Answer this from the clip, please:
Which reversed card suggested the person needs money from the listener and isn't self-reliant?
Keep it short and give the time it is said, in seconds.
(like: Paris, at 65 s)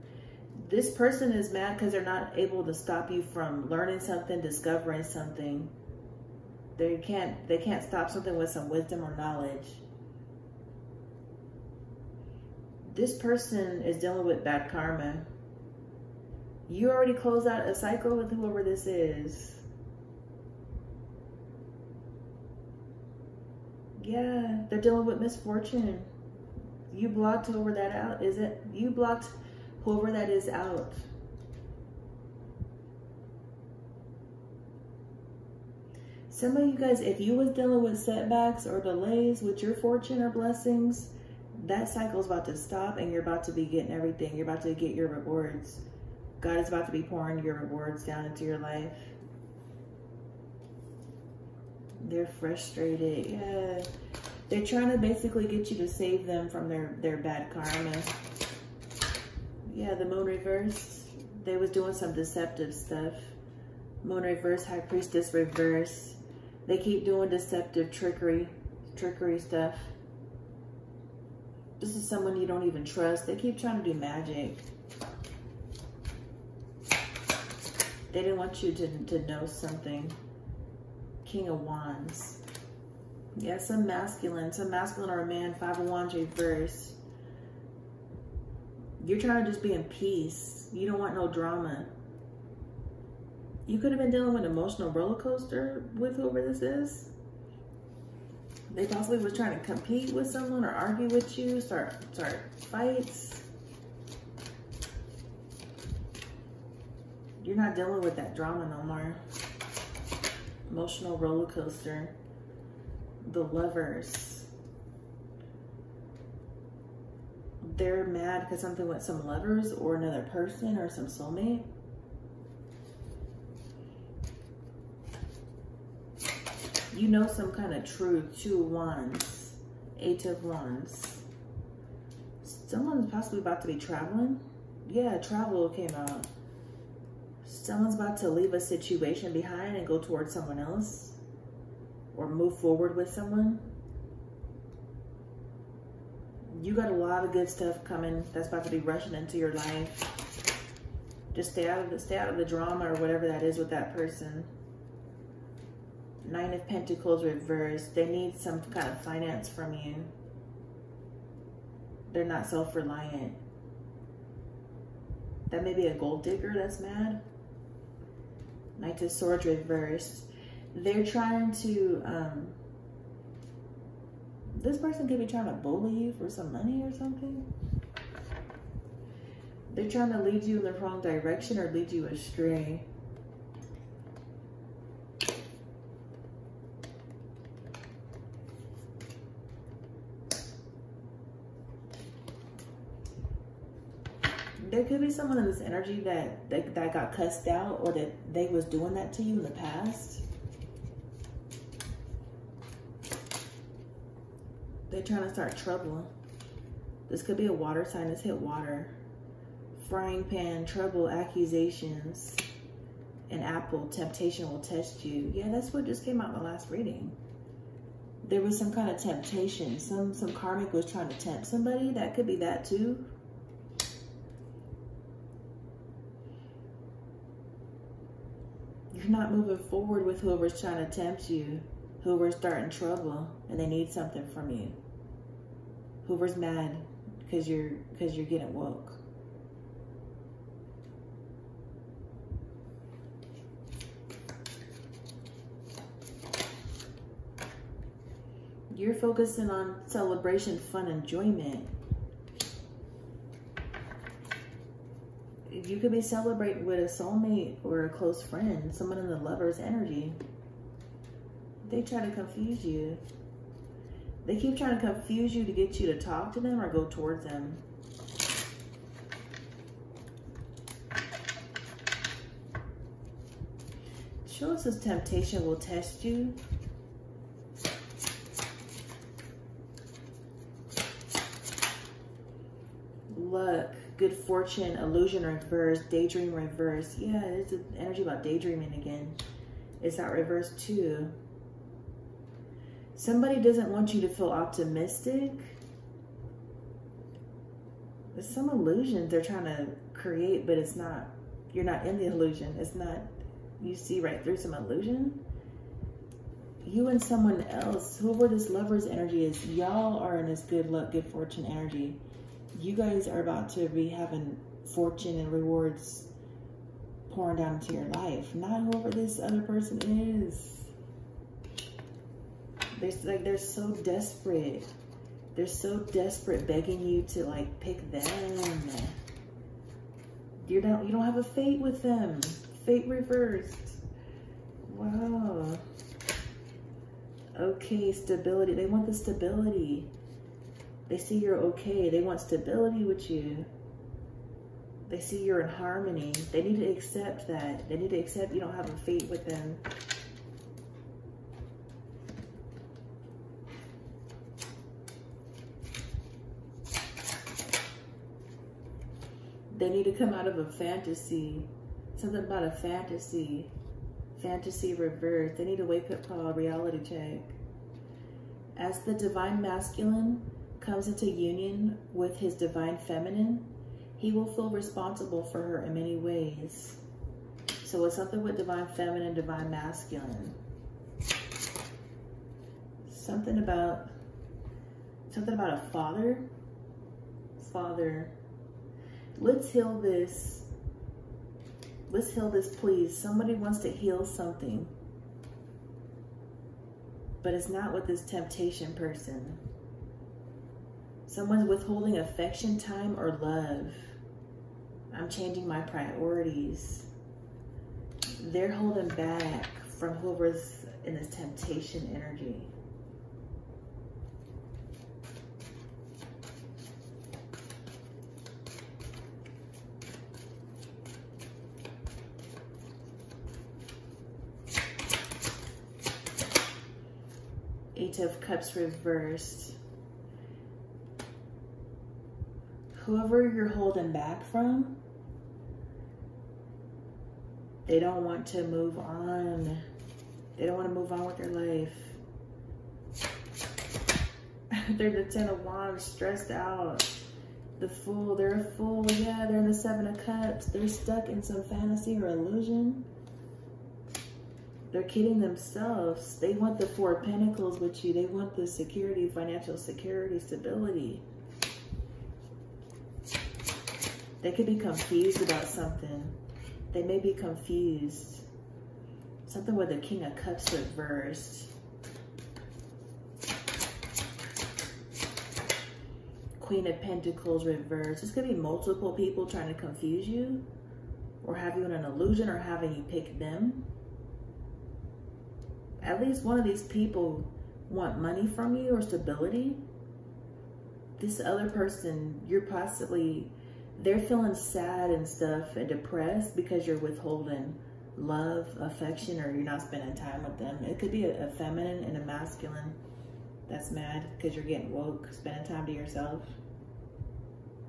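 Nine of Pentacles reversed, at 156 s.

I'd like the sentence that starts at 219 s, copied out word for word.
Some some karmic was trying to tempt somebody.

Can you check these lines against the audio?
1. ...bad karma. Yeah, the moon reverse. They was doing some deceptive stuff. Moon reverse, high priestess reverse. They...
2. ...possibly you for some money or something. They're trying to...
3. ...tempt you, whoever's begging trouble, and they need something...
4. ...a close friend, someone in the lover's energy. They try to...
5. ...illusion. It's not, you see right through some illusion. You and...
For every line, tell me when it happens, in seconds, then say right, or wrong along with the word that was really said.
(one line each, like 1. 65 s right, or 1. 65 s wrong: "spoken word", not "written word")
1. 57 s right
2. 175 s wrong: "bully", not "possibly"
3. 230 s wrong: "starting", not "begging"
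4. 257 s right
5. 302 s right.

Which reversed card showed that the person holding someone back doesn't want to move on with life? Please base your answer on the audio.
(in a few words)
Eight of Cups reversed.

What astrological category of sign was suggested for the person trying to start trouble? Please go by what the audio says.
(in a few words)
Water sign.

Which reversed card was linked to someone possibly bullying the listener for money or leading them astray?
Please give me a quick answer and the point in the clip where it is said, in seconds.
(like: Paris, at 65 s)
Knight of Swords reversed, at 168 s.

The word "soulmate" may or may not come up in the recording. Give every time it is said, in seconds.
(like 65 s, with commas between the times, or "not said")
121 s, 256 s.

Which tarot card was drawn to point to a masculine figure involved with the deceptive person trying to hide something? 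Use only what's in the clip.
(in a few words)
King of Wands.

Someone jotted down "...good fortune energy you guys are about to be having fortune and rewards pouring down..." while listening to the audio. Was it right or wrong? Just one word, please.
right.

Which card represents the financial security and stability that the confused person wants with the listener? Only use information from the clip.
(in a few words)
Four of Pentacles.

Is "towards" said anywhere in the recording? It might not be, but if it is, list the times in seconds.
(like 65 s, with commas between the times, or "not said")
139 s, 266 s.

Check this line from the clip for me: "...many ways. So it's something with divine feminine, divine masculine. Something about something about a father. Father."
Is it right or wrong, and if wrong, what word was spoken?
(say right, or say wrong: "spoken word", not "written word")
right.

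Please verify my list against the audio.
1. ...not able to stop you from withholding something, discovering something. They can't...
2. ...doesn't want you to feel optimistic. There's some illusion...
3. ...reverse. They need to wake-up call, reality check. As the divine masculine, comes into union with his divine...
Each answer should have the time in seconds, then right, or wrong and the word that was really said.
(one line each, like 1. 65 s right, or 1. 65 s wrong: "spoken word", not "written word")
1. 2 s wrong: "learning", not "withholding"
2. 293 s right
3. 364 s right.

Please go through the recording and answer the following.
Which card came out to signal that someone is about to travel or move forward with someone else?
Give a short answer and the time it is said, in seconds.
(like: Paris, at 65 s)
Eight of Wands, at 129 s.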